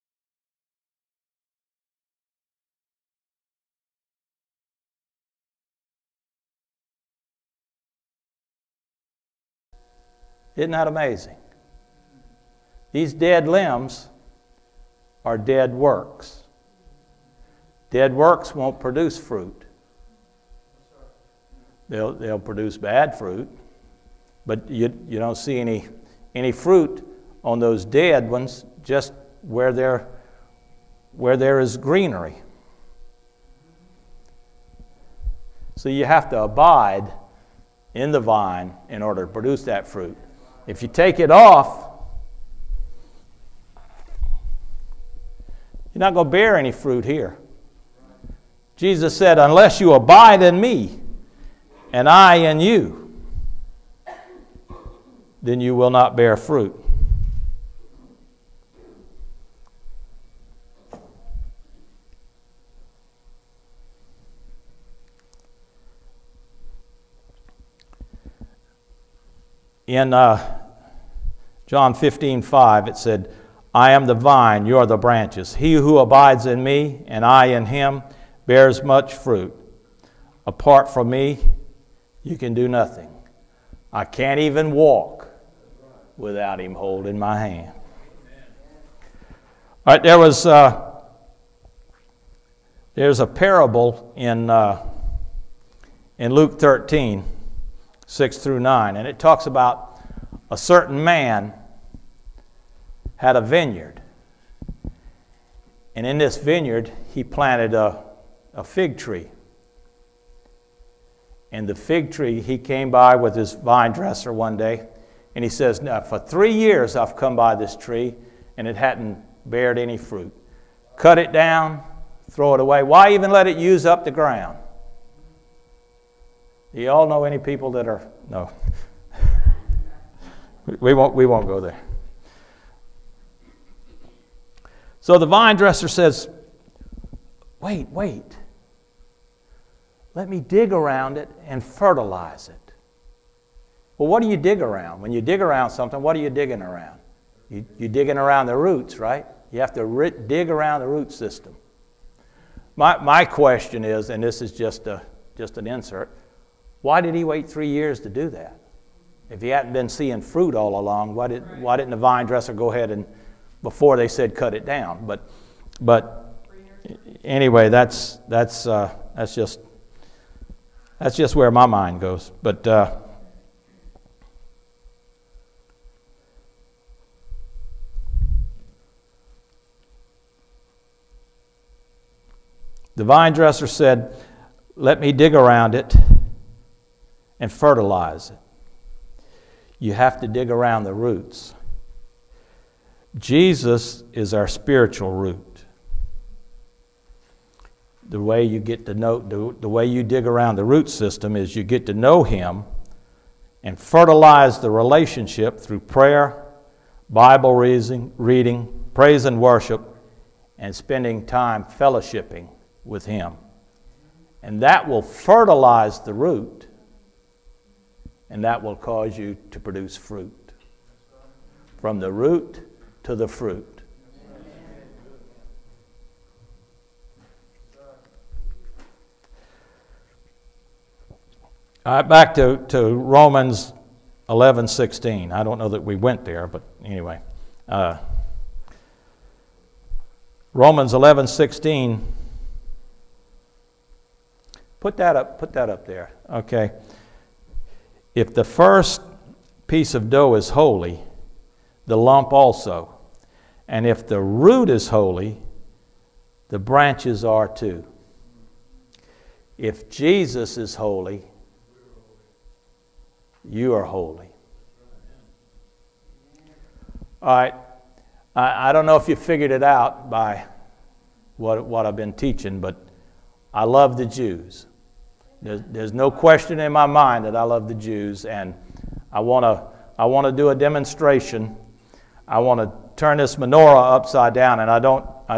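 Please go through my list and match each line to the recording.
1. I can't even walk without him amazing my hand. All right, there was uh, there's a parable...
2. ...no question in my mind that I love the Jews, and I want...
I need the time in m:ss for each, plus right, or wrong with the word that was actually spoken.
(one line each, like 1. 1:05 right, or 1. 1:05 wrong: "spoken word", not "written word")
1. 1:23 wrong: "holding", not "amazing"
2. 4:35 right.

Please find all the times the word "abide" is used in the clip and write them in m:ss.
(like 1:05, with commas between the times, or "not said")
0:36, 0:49, 1:15.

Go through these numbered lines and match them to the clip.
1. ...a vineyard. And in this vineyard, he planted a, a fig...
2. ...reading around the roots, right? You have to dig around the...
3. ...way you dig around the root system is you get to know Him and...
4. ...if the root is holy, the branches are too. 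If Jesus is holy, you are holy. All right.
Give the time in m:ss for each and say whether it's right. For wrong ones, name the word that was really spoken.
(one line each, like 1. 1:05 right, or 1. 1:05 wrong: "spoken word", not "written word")
1. 1:43 right
2. 2:27 wrong: "digging", not "reading"
3. 3:19 right
4. 4:13 right.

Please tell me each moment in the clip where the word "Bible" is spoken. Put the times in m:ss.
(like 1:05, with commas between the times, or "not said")
3:27.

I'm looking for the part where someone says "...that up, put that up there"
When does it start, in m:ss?
4:04.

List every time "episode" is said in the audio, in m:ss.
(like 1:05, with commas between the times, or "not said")
not said.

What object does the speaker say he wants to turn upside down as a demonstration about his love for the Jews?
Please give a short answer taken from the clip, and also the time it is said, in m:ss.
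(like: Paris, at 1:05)
Menorah, at 4:43.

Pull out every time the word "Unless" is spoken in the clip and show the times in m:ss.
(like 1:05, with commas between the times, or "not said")
0:49.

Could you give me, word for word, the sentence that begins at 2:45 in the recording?
But, but anyway, that's, that's, uh, that's, just, that's just where my mind goes.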